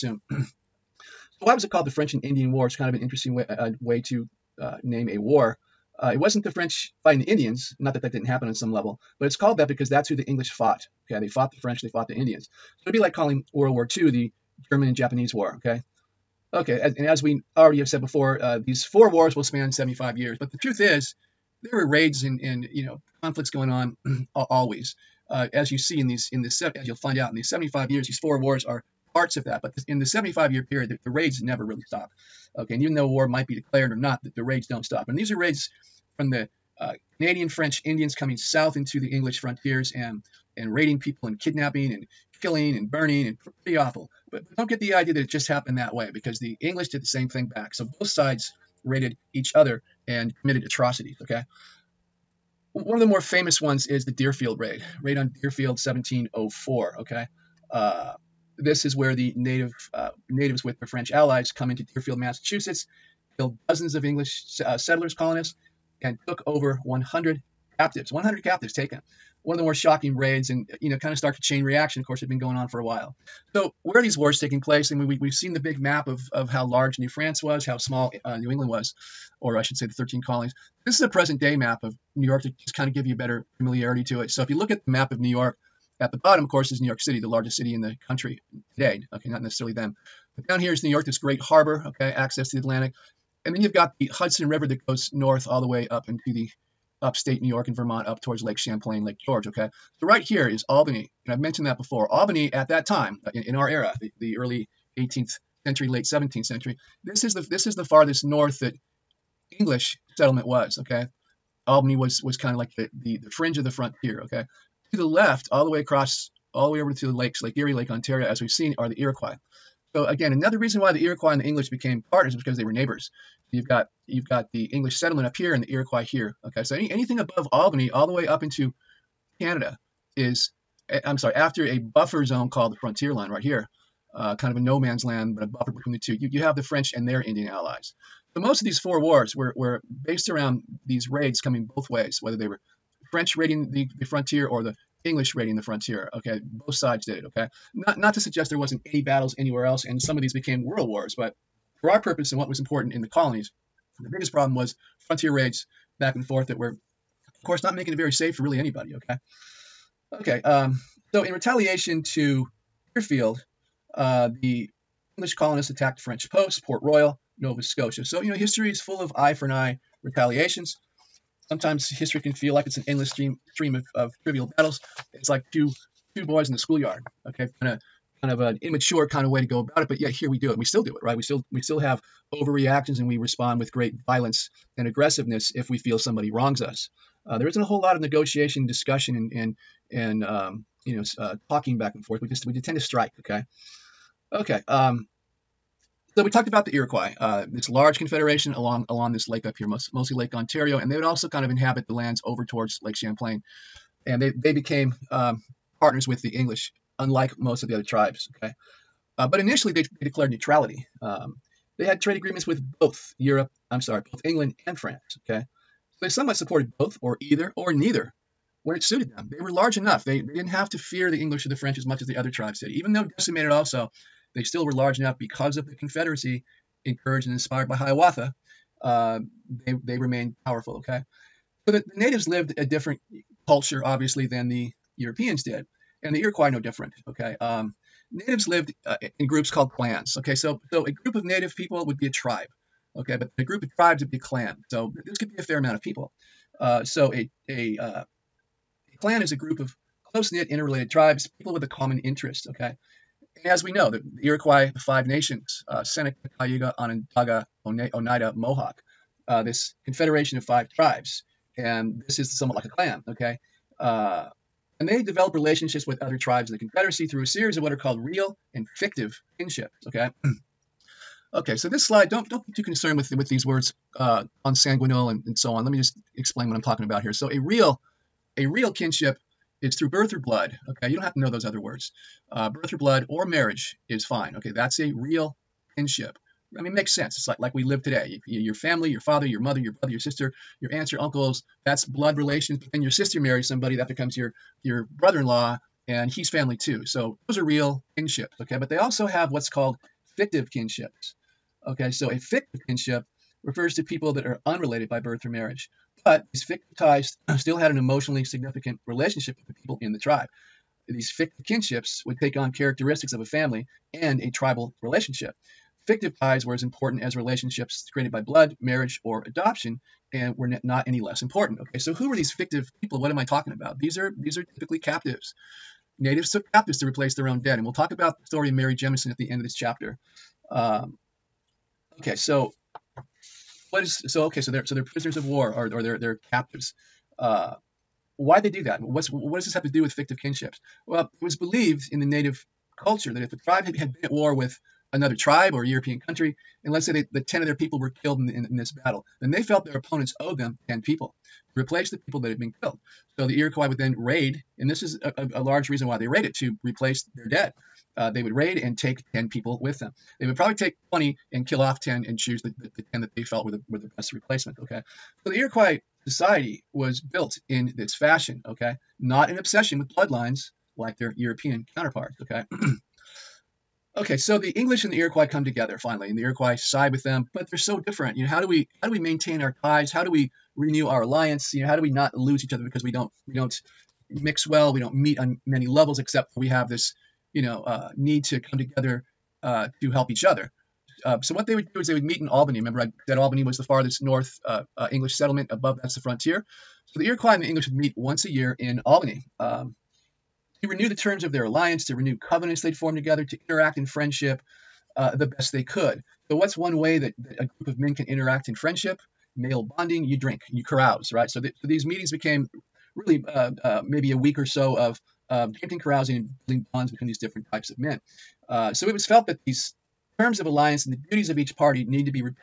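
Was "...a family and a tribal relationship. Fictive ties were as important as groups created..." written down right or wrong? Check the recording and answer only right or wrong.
wrong.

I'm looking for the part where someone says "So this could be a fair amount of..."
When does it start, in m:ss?
4:04.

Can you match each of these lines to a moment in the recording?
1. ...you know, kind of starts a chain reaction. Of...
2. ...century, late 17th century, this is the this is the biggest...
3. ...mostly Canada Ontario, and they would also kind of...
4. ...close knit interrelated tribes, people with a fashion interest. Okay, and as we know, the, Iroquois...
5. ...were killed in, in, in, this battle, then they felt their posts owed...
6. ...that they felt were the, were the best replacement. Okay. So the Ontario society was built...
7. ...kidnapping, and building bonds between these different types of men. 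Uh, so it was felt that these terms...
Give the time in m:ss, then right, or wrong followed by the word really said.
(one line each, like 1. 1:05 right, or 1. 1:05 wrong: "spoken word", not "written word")
1. 1:10 right
2. 1:45 wrong: "farthest", not "biggest"
3. 3:19 wrong: "Lake", not "Canada"
4. 4:10 wrong: "common", not "fashion"
5. 5:47 wrong: "opponents", not "posts"
6. 6:03 wrong: "Iroquois", not "Ontario"
7. 6:55 wrong: "carousing", not "kidnapping".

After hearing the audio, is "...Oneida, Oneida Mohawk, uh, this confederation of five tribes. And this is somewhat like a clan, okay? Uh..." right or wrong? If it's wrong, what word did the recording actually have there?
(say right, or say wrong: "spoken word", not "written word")
right.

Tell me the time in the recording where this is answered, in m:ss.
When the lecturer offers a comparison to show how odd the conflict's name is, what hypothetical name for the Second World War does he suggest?
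0:14.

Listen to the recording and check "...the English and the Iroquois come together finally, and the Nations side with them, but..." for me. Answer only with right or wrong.
wrong.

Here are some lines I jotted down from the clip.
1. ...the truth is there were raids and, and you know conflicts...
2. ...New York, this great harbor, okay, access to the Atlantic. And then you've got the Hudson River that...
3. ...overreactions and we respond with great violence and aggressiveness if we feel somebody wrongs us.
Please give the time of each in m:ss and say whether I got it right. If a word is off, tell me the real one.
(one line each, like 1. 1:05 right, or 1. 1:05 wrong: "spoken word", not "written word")
1. 0:20 right
2. 1:30 right
3. 3:02 right.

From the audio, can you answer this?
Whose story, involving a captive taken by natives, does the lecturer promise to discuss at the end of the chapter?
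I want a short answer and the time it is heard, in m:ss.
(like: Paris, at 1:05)
Mary Jemison, at 5:28.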